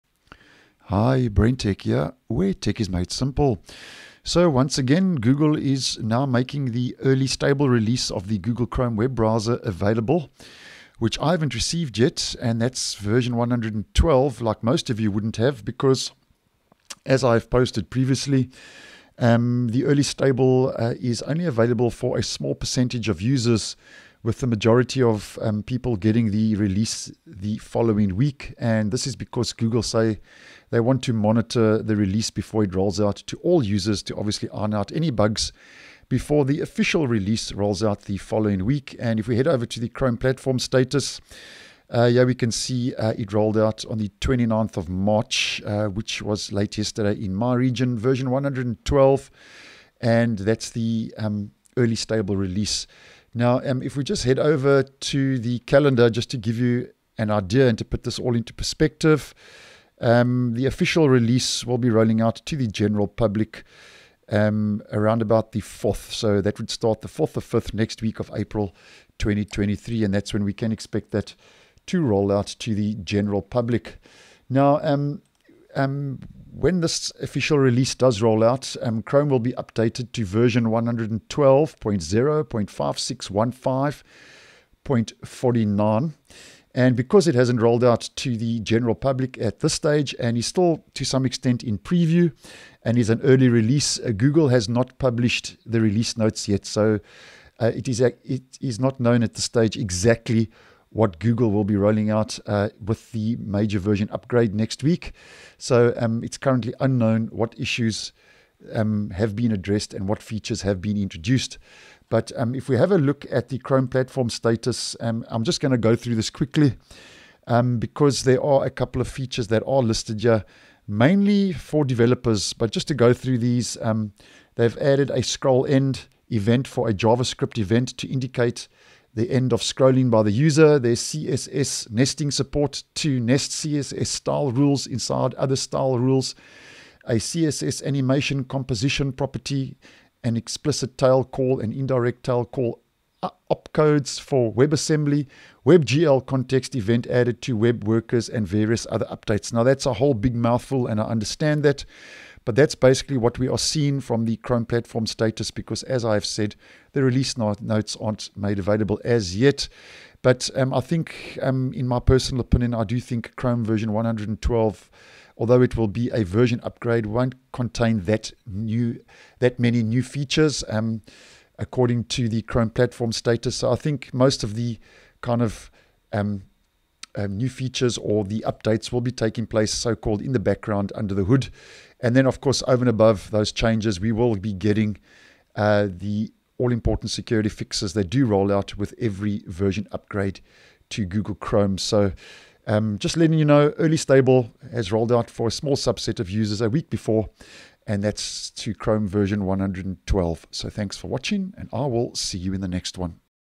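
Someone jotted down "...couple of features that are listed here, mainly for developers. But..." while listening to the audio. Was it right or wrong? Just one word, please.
right.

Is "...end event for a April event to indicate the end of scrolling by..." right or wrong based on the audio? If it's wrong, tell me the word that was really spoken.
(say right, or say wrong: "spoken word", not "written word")
wrong: "JavaScript", not "April".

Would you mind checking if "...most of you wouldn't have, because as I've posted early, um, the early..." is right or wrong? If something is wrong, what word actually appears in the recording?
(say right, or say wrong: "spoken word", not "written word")
wrong: "previously", not "early".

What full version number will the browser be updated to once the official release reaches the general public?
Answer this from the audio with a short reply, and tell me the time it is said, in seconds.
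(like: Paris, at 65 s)
112.0.5615.49, at 80 s.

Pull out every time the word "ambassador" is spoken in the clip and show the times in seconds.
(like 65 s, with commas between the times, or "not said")
not said.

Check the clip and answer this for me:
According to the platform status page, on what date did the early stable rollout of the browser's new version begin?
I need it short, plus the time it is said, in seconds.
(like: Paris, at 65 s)
29th of March, at 44 s.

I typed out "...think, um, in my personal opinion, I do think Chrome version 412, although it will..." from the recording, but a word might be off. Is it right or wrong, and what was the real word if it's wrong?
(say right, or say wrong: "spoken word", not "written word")
wrong: "112", not "412".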